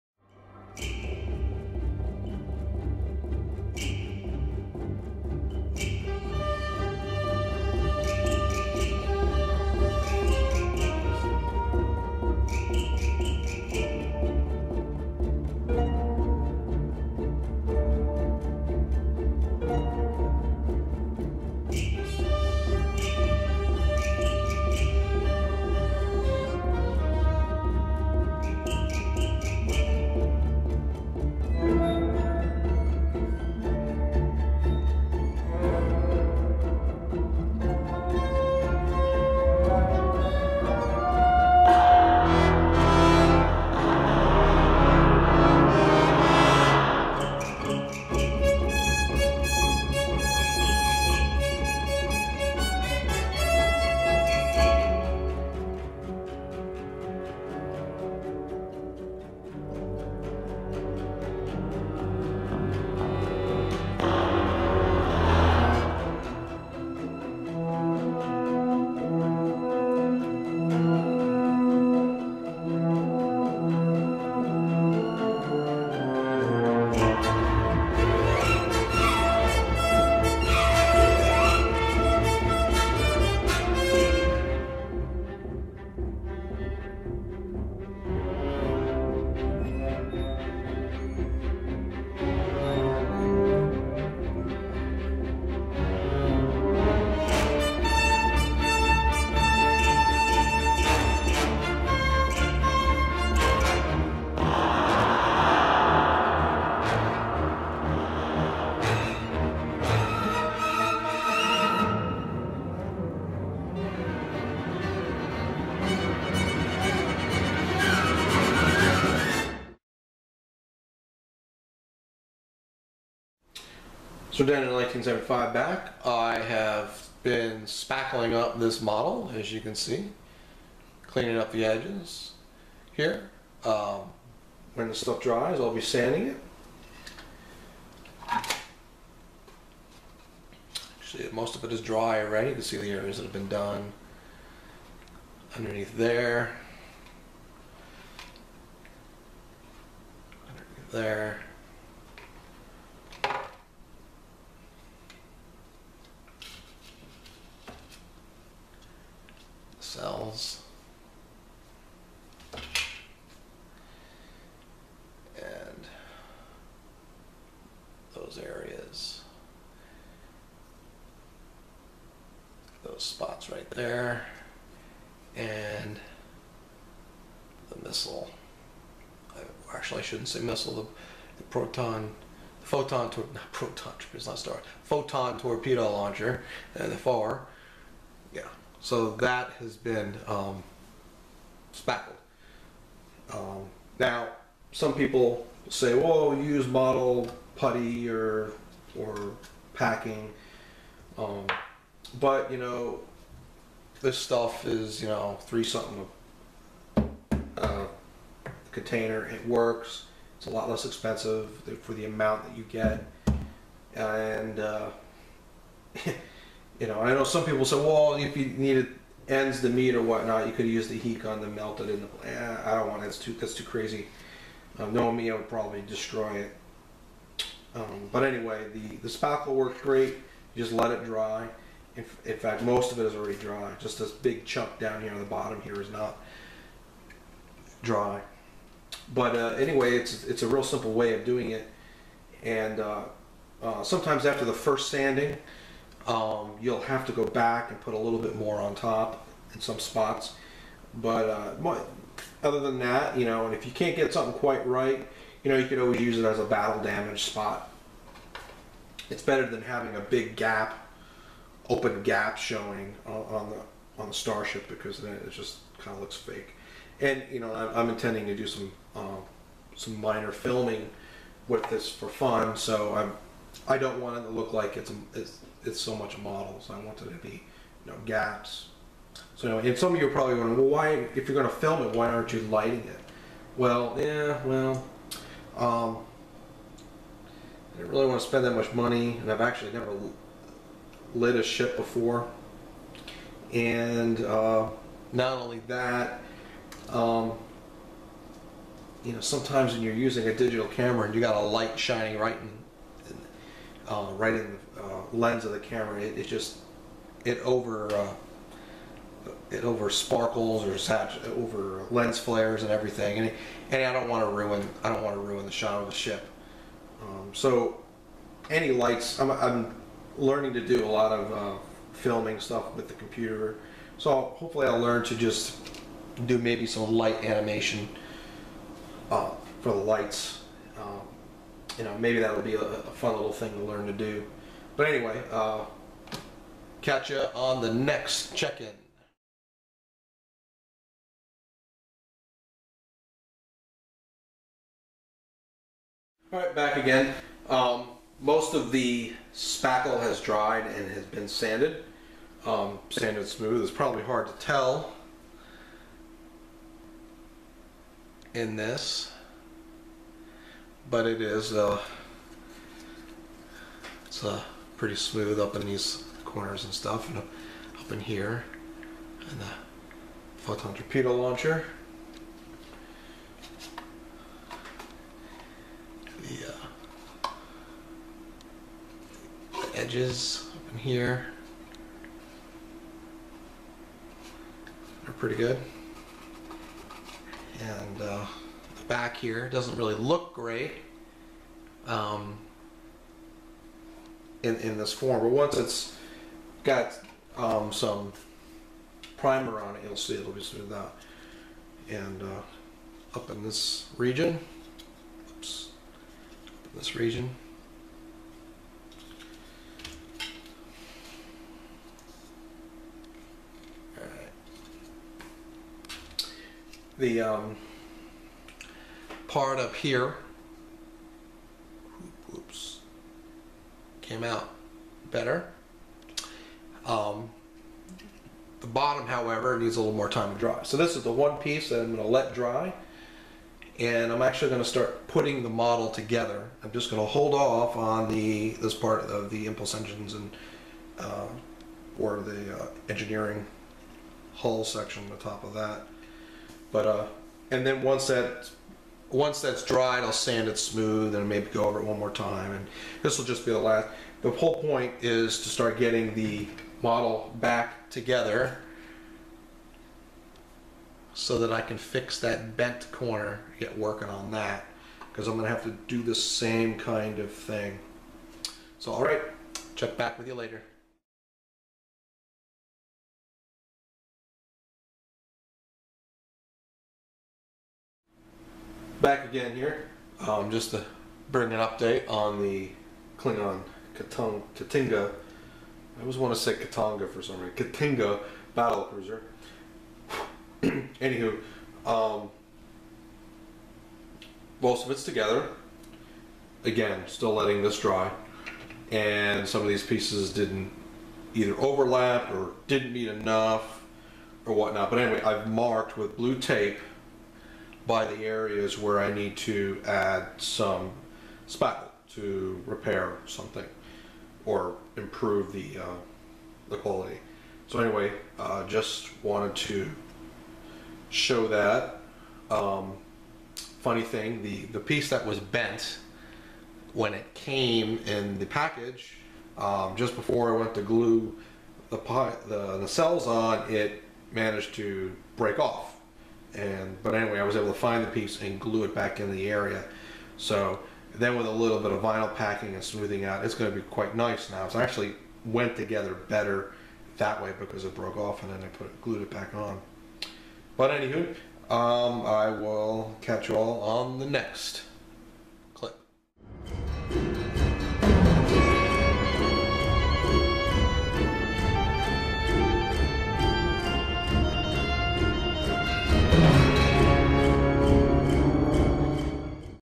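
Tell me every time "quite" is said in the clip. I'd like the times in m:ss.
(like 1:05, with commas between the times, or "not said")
4:14, 9:03.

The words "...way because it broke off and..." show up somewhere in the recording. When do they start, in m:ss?
9:07.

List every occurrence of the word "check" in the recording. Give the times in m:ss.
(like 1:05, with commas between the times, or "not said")
5:38, 7:49.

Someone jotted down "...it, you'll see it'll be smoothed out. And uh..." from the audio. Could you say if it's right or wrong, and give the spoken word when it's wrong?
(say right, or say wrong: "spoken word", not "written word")
right.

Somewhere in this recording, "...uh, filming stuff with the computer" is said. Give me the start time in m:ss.
5:21.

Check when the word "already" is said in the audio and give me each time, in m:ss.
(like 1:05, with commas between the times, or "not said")
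2:22, 3:53.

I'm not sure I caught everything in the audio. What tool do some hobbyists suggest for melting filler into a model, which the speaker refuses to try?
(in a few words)
Heat gun.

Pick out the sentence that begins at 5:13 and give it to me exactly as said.
And and I don't want to ruin I don't want to ruin the shot of the ship.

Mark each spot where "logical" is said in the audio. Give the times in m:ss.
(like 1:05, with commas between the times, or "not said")
not said.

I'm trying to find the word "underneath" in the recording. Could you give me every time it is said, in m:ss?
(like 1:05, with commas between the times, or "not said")
2:25, 2:30.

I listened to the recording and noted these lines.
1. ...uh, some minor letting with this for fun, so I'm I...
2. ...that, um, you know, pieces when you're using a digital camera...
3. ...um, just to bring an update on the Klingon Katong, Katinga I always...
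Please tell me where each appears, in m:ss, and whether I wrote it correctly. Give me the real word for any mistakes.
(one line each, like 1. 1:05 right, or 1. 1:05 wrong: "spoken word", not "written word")
1. 4:28 wrong: "filming", not "letting"
2. 4:55 wrong: "sometimes", not "pieces"
3. 8:00 right.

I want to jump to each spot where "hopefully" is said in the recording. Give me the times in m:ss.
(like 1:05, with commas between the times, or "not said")
5:24.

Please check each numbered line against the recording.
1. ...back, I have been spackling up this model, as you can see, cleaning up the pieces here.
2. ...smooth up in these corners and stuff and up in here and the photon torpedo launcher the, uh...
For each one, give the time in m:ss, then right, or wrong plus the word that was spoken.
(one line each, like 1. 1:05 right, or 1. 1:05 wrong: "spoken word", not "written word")
1. 2:05 wrong: "edges", not "pieces"
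2. 6:04 right.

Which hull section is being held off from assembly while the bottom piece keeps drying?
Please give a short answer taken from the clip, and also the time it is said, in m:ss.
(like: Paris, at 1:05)
Engineering hull section, at 7:22.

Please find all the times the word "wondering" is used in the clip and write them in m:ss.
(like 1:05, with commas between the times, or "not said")
4:40.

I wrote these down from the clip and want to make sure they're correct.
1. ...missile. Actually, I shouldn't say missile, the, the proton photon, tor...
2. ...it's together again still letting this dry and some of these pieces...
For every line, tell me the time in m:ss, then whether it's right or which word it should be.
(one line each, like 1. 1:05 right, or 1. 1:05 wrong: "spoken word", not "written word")
1. 2:57 right
2. 8:14 right.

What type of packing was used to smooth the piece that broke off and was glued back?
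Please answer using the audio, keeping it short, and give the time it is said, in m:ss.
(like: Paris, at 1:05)
Vinyl packing, at 9:02.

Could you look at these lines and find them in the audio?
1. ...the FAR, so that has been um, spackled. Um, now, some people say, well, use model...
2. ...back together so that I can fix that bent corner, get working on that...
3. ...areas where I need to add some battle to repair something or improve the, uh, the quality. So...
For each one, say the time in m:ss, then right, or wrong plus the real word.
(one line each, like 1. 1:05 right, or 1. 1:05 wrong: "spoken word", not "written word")
1. 3:06 right
2. 7:37 right
3. 8:28 wrong: "spackle", not "battle".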